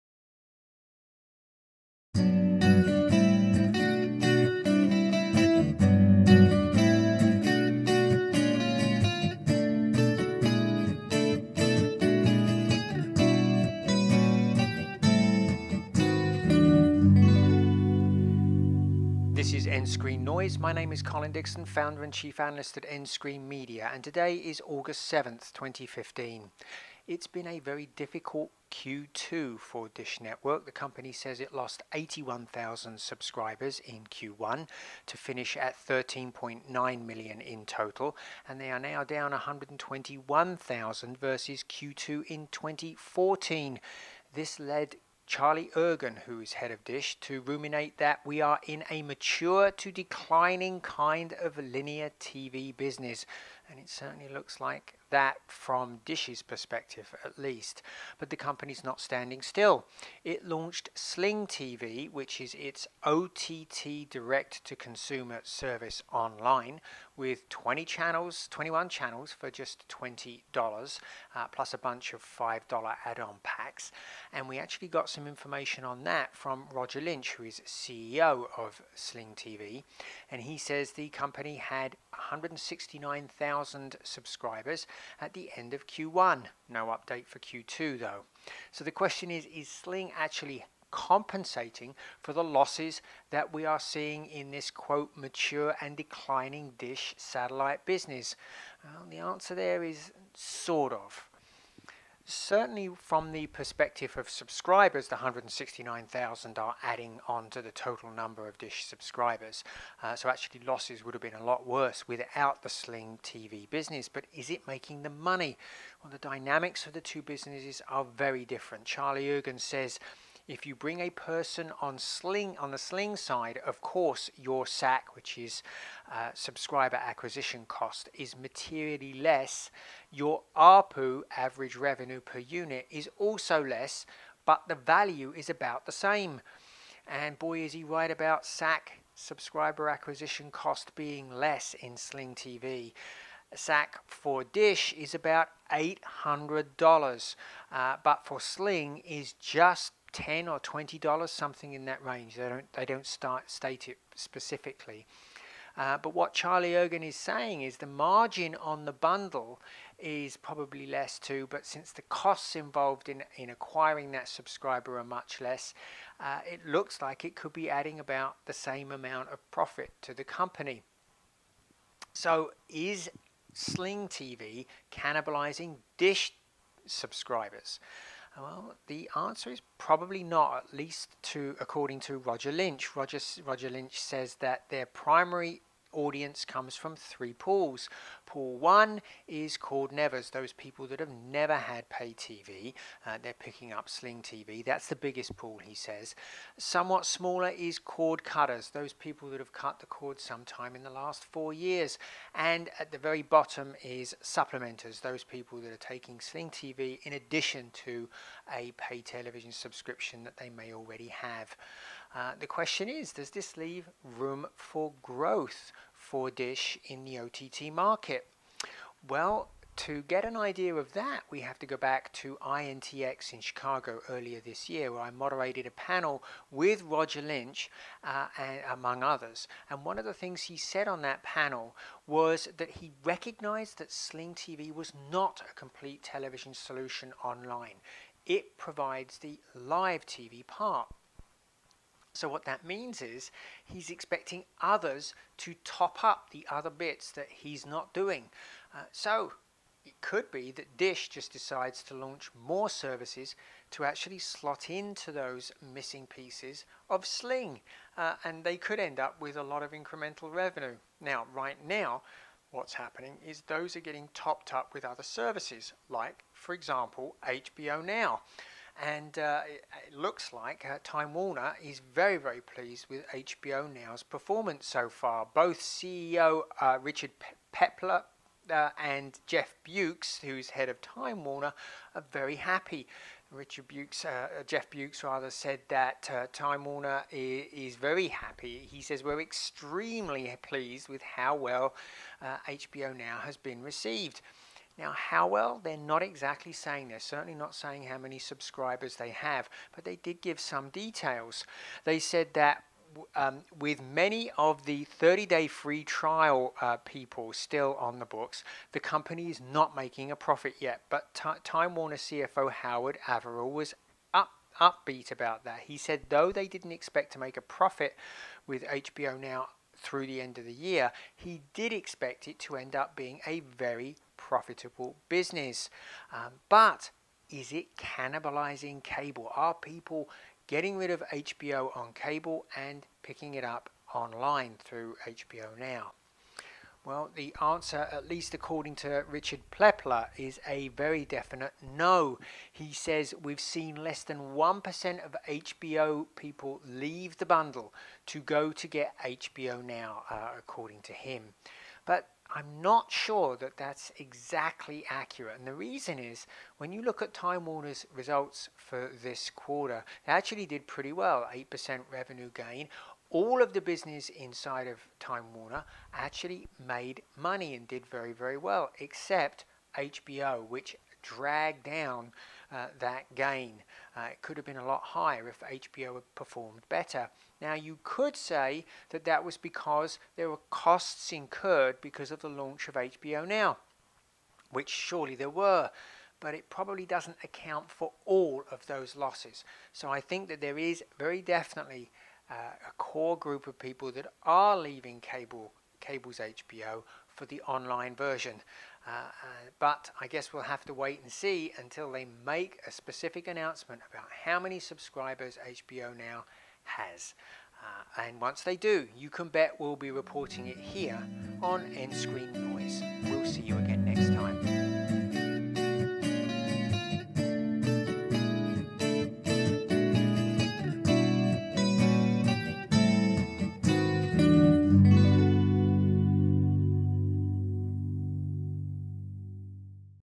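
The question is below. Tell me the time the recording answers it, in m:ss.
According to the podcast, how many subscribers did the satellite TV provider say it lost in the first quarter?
0:31.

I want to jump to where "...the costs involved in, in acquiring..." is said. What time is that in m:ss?
2:41.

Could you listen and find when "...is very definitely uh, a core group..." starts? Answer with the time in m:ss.
6:30.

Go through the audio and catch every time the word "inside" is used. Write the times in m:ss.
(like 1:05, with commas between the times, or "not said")
6:04.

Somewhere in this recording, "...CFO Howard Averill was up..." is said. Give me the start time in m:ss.
5:11.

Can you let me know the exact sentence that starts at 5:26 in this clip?
Um, but is it cannibalizing cable?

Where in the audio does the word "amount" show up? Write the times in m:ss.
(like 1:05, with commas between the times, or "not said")
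2:48.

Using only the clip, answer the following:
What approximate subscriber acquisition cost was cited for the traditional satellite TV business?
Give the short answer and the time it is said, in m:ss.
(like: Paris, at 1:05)
$800, at 2:25.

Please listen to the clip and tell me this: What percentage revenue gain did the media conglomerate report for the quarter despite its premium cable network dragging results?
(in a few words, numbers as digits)
8%.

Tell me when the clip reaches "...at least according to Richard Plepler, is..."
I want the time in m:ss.
5:37.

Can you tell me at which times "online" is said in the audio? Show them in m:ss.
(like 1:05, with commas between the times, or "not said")
1:06, 3:57, 5:33, 6:37.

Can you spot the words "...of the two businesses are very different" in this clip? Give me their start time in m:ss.
1:56.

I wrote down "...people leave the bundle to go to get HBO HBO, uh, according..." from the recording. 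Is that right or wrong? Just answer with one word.
wrong.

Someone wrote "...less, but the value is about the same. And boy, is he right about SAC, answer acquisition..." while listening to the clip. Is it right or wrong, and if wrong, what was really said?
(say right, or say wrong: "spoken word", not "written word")
wrong: "subscriber", not "answer".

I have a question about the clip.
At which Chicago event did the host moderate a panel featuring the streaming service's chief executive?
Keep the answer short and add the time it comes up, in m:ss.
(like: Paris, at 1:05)
INTX, at 3:42.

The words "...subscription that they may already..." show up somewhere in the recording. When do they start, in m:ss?
3:29.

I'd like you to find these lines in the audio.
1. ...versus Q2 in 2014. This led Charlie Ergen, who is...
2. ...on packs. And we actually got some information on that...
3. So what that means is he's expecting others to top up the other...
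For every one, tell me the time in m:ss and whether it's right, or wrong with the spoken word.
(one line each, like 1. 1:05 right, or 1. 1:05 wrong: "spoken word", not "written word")
1. 0:41 right
2. 1:13 right
3. 4:02 right.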